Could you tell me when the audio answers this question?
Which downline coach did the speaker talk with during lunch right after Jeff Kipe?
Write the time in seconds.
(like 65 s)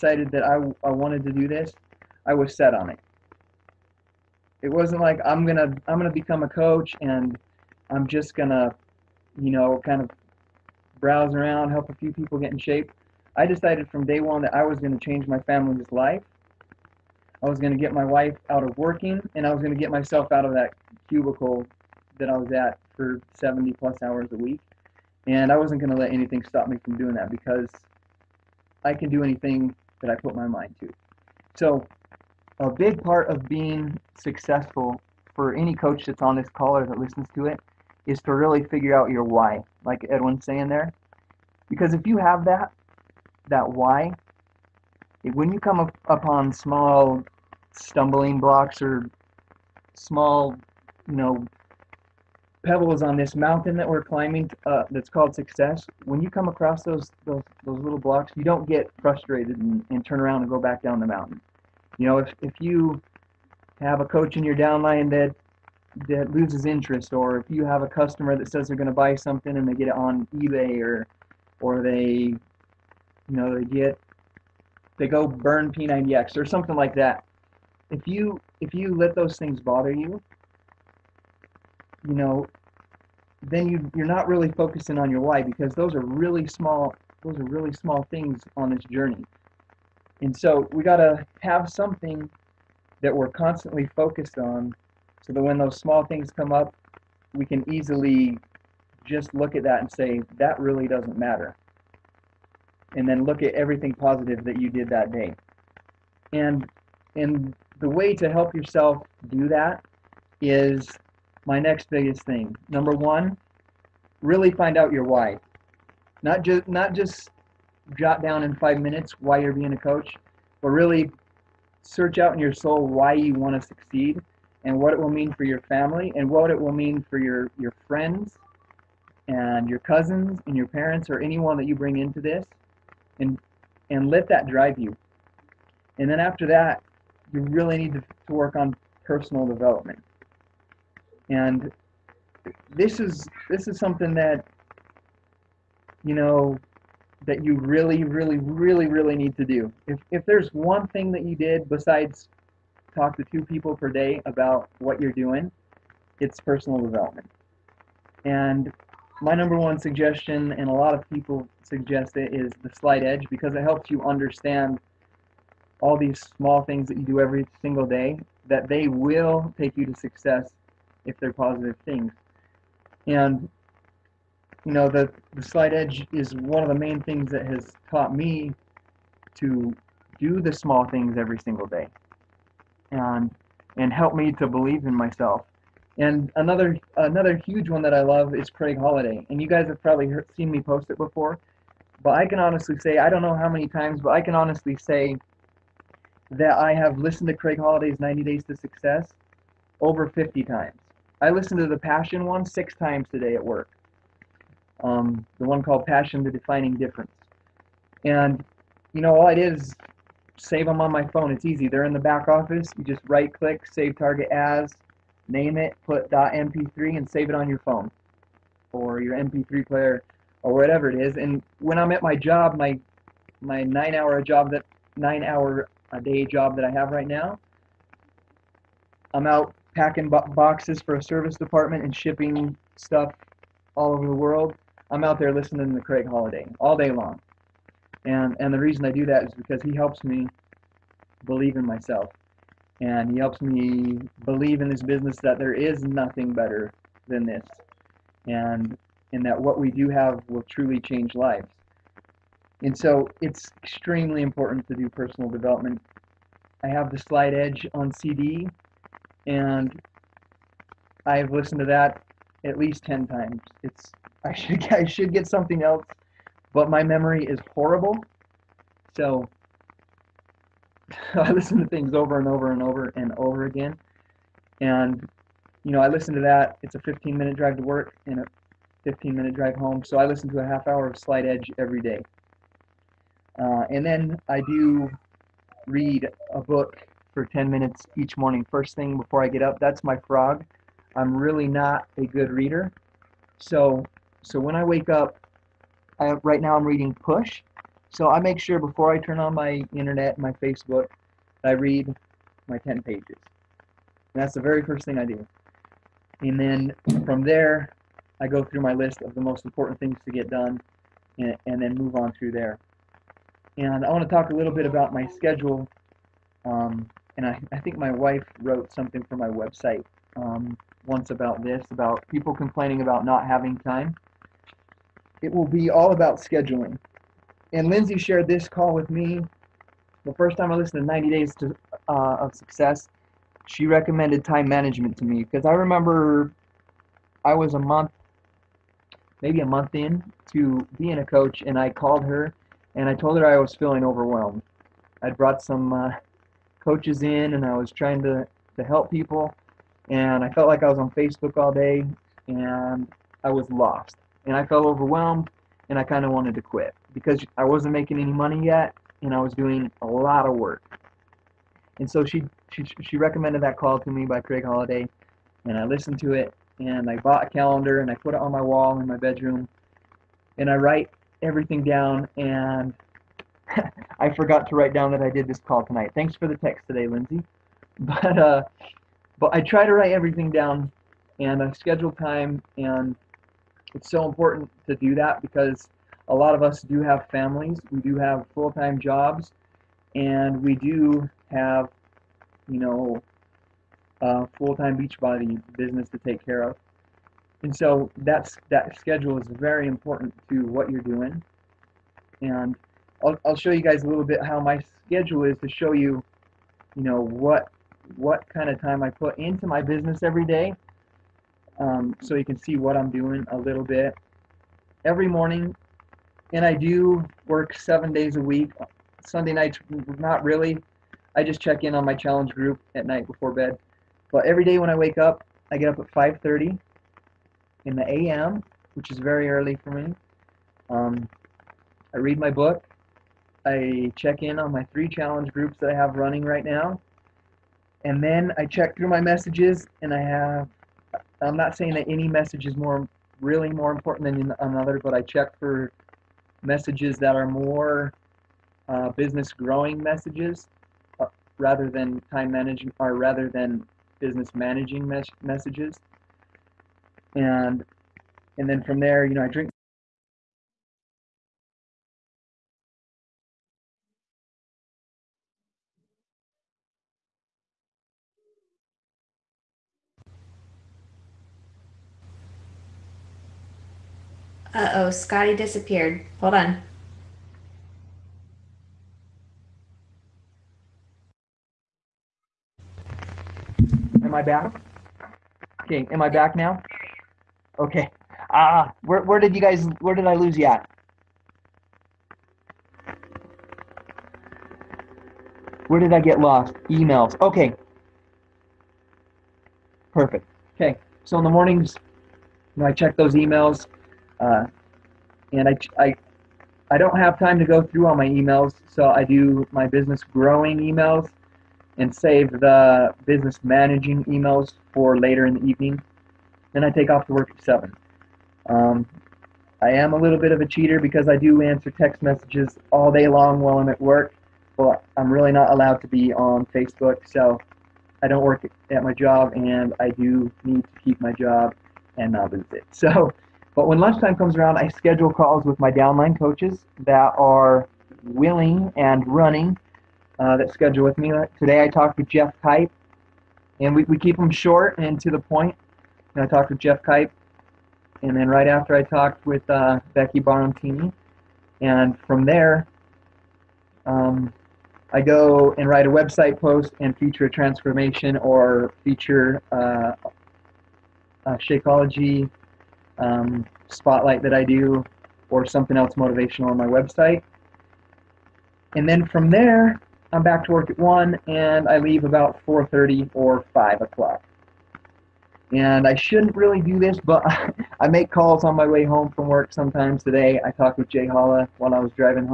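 549 s.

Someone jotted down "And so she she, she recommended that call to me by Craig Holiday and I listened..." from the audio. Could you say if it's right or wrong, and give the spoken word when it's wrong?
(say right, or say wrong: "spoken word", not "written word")
right.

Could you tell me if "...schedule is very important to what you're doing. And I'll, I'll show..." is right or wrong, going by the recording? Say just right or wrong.
right.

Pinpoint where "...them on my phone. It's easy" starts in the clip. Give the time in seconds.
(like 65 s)
210 s.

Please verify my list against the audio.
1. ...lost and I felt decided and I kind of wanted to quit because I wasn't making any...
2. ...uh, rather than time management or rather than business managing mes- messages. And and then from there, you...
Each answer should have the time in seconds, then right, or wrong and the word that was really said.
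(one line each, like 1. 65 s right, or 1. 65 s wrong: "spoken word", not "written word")
1. 353 s wrong: "overwhelmed", not "decided"
2. 450 s right.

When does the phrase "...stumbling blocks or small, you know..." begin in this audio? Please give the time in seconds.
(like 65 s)
47 s.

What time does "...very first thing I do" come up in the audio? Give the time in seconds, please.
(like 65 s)
304 s.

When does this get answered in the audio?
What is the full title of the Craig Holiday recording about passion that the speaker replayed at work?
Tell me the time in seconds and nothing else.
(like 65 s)
205 s.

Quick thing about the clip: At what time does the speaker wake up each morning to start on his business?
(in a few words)
5:30 a.m.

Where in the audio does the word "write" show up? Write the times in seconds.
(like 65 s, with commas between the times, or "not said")
370 s, 374 s, 379 s, 555 s.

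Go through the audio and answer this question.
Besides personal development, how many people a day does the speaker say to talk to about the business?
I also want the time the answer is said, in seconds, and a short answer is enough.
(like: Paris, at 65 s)
2, at 153 s.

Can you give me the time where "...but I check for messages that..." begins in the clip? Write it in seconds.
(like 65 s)
444 s.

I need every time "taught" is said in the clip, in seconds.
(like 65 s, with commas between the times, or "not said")
177 s.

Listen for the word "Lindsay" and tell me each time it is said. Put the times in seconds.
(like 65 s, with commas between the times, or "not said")
327 s, 376 s.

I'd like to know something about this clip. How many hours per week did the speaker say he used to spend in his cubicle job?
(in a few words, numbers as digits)
70 plus.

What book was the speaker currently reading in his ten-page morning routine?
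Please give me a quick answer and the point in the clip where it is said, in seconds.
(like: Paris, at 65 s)
Push, at 296 s.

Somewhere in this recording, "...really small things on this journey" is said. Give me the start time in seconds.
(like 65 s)
87 s.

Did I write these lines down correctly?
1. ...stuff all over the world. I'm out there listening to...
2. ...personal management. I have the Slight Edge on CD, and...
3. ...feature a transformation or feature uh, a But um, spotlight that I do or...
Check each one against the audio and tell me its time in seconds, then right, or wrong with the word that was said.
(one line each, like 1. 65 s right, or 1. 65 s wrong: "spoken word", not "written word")
1. 232 s right
2. 254 s wrong: "development", not "management"
3. 556 s wrong: "Shakeology", not "But".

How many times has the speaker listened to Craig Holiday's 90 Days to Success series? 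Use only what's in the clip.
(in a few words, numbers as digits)
over 50.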